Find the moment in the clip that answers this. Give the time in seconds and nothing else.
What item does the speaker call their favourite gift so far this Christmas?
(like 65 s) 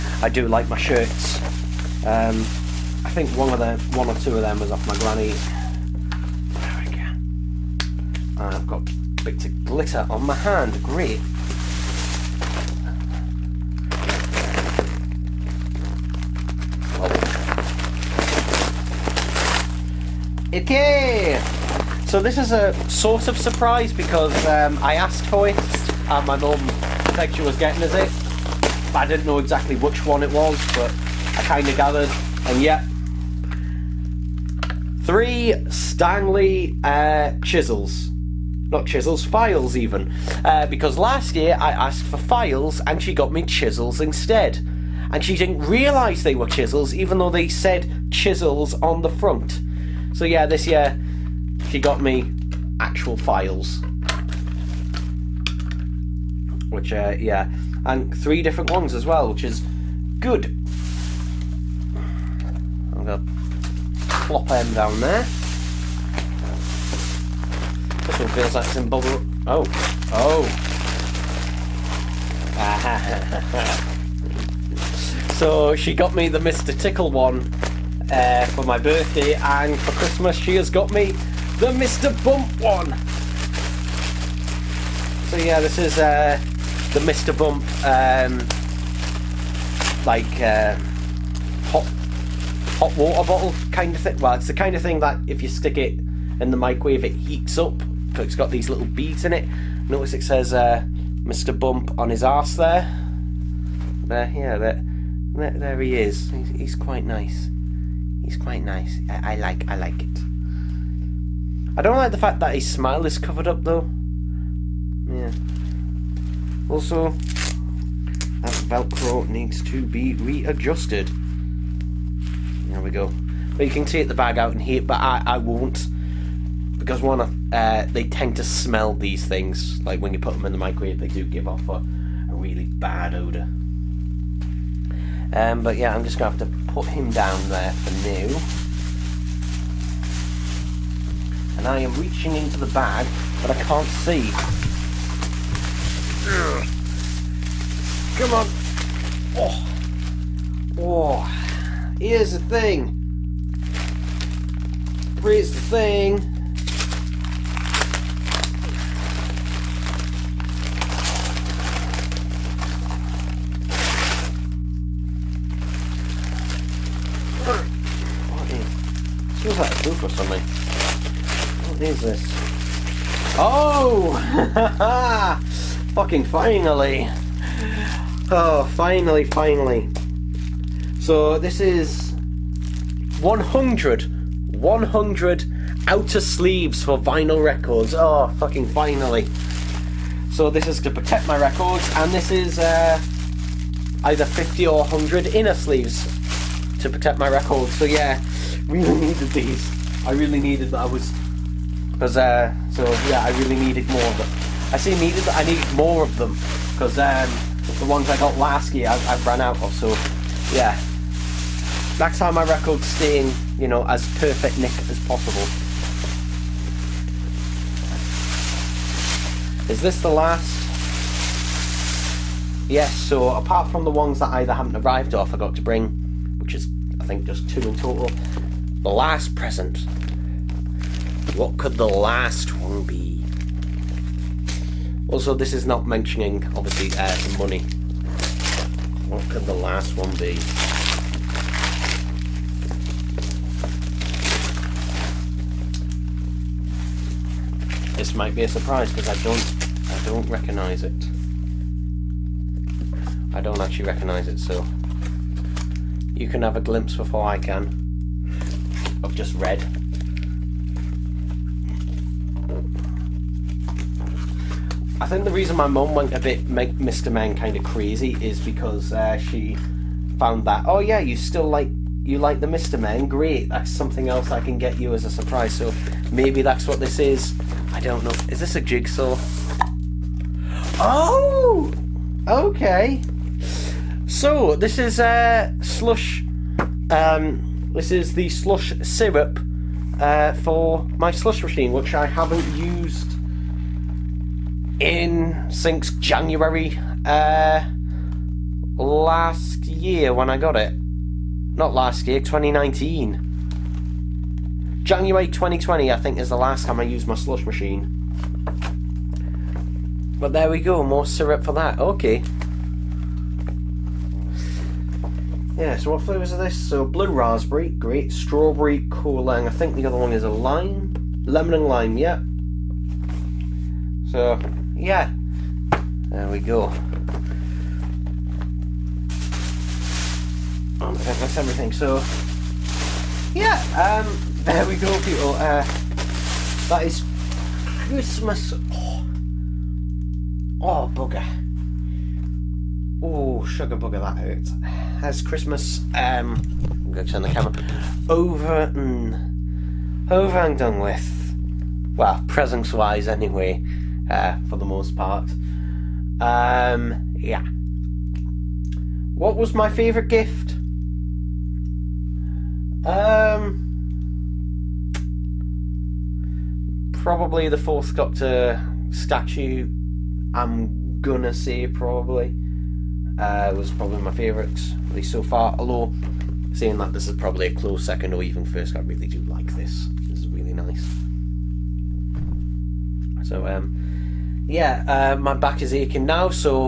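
367 s.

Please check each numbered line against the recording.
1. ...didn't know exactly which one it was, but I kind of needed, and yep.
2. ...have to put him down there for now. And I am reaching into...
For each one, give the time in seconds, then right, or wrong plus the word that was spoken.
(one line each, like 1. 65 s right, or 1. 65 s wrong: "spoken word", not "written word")
1. 29 s wrong: "gathered", not "needed"
2. 136 s right.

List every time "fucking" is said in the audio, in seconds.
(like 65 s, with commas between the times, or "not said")
175 s, 188 s.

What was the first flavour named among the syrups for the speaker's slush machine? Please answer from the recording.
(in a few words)
blue raspberry.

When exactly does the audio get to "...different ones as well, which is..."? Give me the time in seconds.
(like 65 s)
58 s.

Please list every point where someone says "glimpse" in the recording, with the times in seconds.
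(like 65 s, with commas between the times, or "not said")
256 s.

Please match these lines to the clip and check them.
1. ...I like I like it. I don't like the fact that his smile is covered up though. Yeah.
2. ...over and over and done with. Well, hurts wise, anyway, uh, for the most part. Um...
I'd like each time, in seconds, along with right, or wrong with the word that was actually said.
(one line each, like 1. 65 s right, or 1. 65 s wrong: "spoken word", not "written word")
1. 109 s right
2. 348 s wrong: "presents", not "hurts".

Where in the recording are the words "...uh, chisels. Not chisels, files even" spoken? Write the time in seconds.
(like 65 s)
36 s.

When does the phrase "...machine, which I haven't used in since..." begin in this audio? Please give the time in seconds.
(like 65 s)
291 s.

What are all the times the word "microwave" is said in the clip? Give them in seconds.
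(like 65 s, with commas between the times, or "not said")
96 s, 130 s.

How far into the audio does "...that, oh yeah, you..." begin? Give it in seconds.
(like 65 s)
270 s.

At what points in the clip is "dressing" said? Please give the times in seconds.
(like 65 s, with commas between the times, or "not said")
not said.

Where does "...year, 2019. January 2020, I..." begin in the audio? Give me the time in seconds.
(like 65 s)
302 s.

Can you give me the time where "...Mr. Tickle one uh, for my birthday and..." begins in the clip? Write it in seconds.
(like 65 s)
76 s.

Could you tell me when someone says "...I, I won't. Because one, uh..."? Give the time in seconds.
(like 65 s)
125 s.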